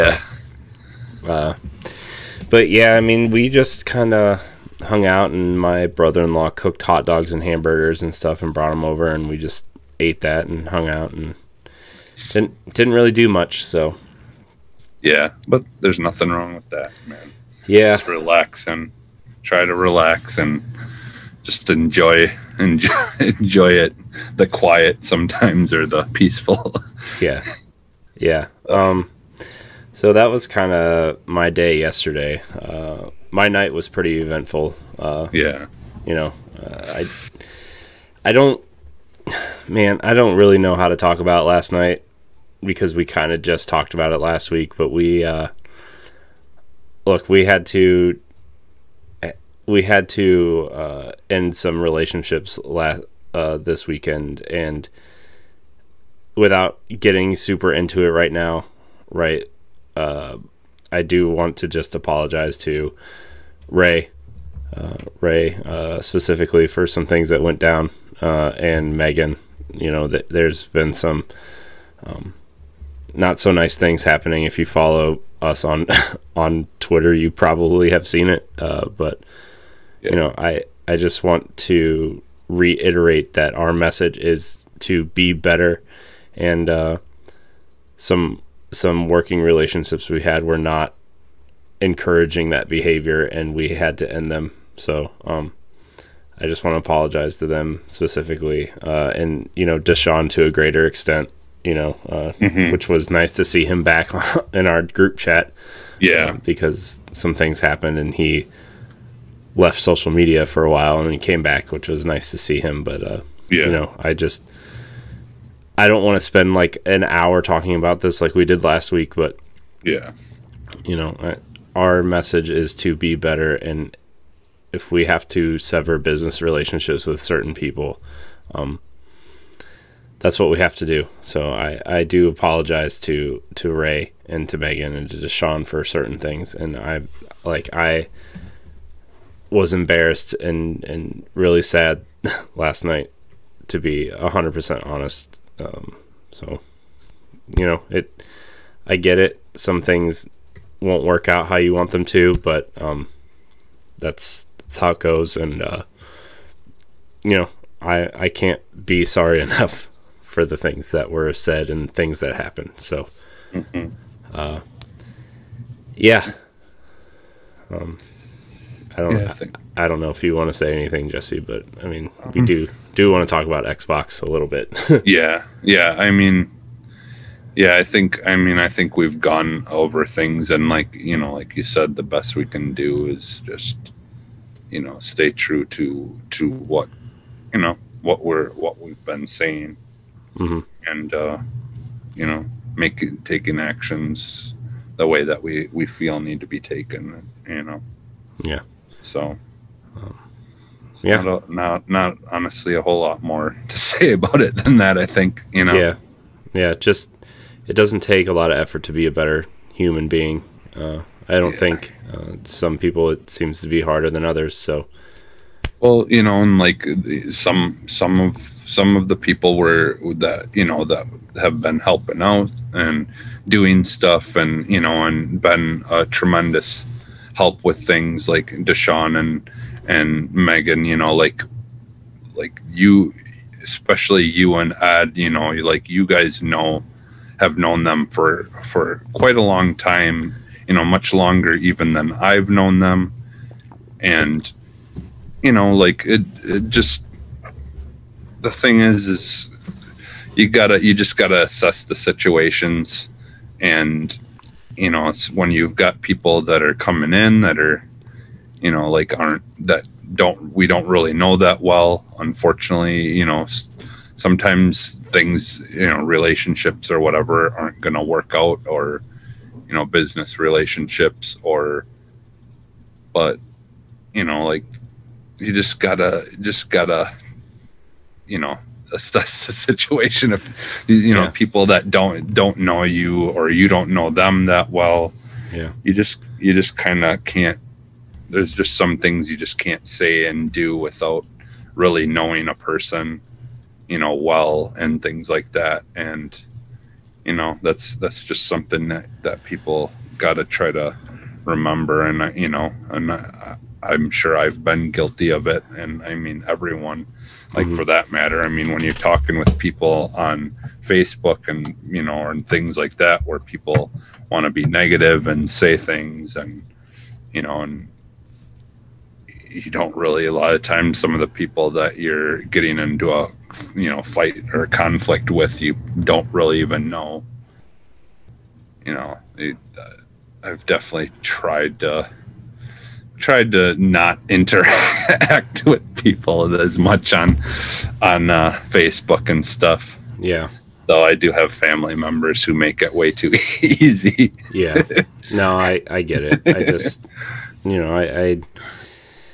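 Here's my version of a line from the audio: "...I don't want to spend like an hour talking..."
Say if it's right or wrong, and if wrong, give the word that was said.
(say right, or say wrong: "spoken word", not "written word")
right.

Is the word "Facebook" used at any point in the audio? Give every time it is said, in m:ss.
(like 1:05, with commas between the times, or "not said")
5:10, 5:38.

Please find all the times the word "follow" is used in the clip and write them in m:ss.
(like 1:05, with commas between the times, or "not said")
1:14.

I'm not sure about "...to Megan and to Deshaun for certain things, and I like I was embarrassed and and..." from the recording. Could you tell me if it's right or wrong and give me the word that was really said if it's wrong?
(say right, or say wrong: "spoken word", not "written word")
right.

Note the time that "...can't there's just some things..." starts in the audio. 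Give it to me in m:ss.
4:47.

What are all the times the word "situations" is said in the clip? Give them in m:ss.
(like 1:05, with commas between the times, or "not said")
4:11, 4:39.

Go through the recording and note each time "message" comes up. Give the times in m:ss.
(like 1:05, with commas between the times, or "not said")
1:23, 2:02.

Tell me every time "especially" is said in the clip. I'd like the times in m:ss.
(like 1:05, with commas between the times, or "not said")
3:53.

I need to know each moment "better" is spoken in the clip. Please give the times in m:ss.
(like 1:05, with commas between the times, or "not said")
1:25, 2:03, 3:29.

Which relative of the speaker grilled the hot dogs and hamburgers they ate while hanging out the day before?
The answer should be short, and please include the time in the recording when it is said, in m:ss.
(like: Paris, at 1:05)
Brother-in-law, at 0:05.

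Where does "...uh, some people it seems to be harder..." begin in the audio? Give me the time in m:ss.
3:32.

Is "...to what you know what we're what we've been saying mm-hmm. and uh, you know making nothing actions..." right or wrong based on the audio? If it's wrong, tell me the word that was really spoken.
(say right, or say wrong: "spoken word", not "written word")
wrong: "taking", not "nothing".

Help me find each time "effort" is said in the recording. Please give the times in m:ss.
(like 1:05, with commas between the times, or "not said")
3:28.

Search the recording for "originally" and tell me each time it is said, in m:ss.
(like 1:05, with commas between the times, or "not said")
not said.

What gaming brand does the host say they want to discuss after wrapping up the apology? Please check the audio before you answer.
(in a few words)
Xbox.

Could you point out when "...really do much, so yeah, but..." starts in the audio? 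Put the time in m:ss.
0:12.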